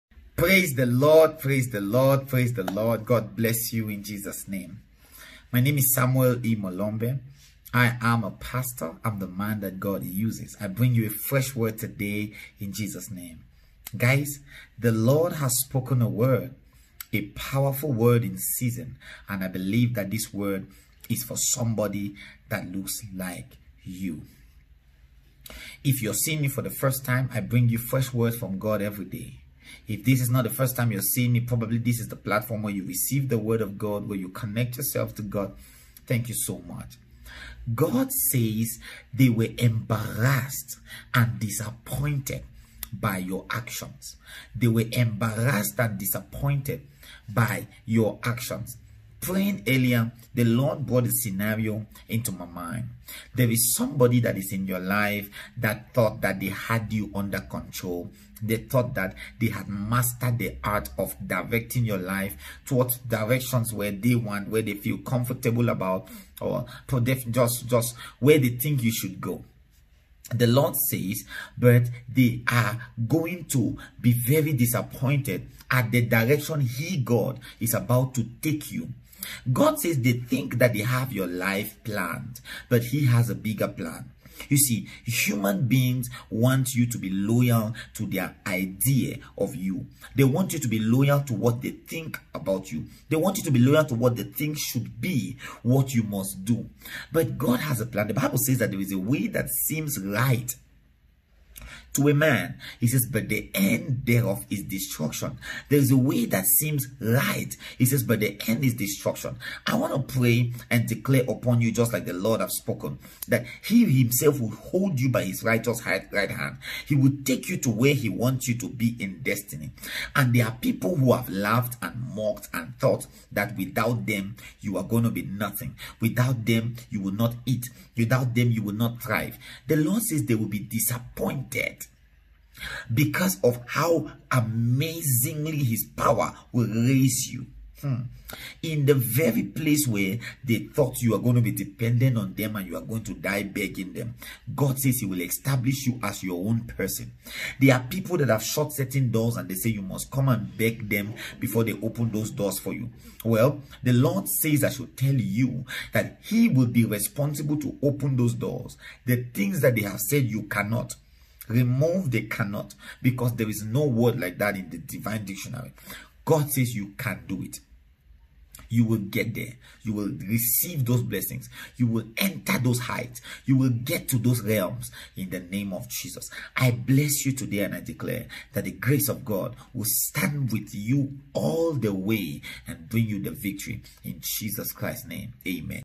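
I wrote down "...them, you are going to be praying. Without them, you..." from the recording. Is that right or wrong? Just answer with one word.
wrong.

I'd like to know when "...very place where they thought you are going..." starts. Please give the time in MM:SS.
02:18.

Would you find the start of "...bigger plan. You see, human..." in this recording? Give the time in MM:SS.
01:23.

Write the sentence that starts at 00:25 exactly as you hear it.
If you're seeing me for the first time, I bring you fresh words from God every day.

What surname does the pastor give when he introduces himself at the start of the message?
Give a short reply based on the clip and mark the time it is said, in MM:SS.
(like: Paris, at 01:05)
Molombe, at 00:06.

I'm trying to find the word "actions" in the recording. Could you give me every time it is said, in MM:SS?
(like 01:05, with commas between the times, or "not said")
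00:43, 00:48.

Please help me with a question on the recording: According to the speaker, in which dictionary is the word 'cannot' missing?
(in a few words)
the divine dictionary.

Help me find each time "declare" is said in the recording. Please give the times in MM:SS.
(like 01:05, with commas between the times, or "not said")
01:50, 02:57.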